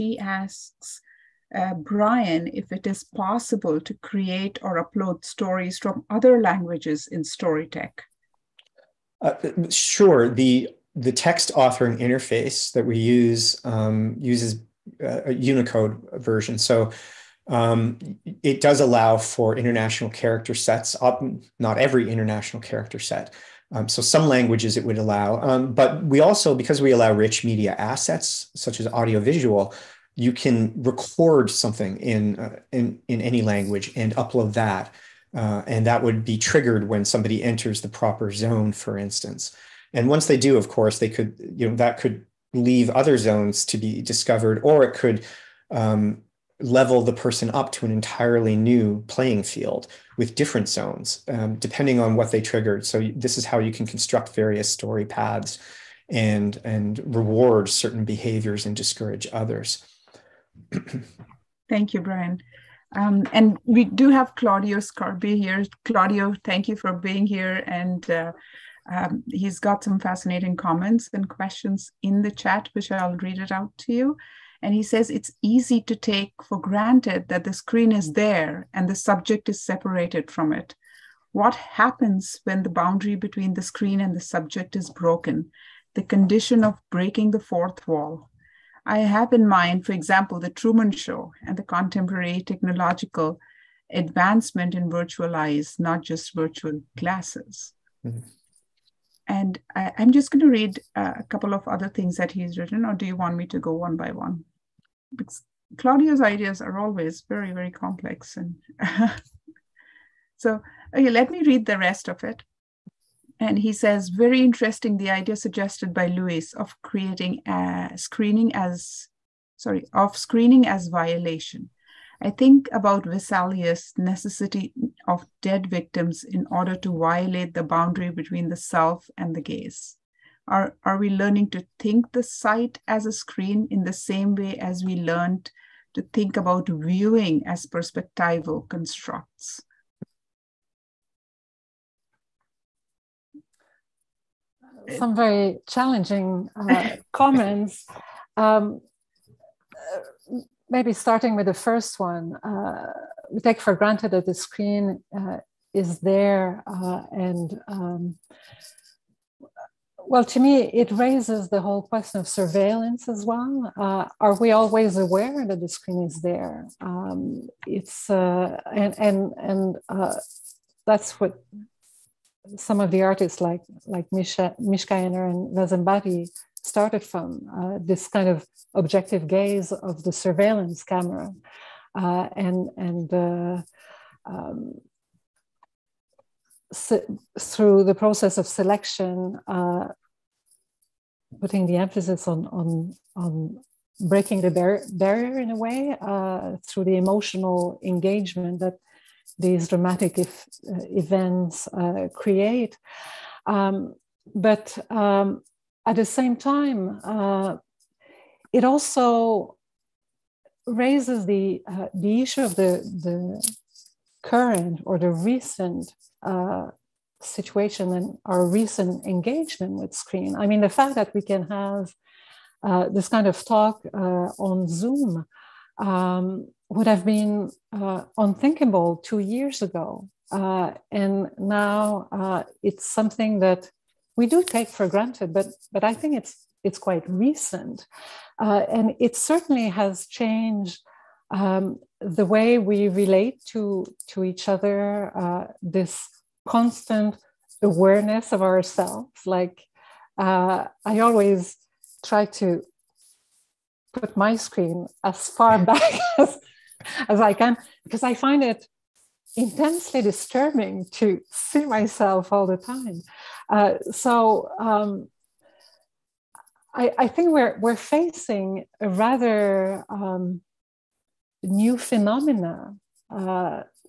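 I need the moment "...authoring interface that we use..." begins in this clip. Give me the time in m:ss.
0:11.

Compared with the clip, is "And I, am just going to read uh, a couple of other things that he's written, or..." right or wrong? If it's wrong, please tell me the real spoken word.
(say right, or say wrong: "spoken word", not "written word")
right.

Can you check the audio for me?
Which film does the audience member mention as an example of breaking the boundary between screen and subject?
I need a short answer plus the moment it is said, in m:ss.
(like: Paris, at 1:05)
The Truman Show, at 1:30.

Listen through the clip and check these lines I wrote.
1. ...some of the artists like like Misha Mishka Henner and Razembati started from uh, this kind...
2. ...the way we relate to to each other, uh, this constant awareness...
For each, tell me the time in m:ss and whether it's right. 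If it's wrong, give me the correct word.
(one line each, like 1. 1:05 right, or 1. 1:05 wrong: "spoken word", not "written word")
1. 2:52 right
2. 4:01 right.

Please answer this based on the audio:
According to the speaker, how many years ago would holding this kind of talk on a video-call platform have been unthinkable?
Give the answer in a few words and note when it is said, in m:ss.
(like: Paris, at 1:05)
2 years, at 3:48.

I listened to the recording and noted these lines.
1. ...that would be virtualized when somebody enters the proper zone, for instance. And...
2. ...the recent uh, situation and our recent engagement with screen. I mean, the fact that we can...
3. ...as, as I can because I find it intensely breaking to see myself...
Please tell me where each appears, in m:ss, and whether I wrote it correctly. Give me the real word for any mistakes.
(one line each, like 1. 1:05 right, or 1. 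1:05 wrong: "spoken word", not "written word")
1. 0:35 wrong: "triggered", not "virtualized"
2. 3:34 right
3. 4:16 wrong: "disturbing", not "breaking".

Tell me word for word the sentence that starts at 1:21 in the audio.
What happens when the boundary between the screen and the subject is broken?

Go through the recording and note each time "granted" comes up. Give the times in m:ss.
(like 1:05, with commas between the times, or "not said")
1:16, 2:33, 3:54.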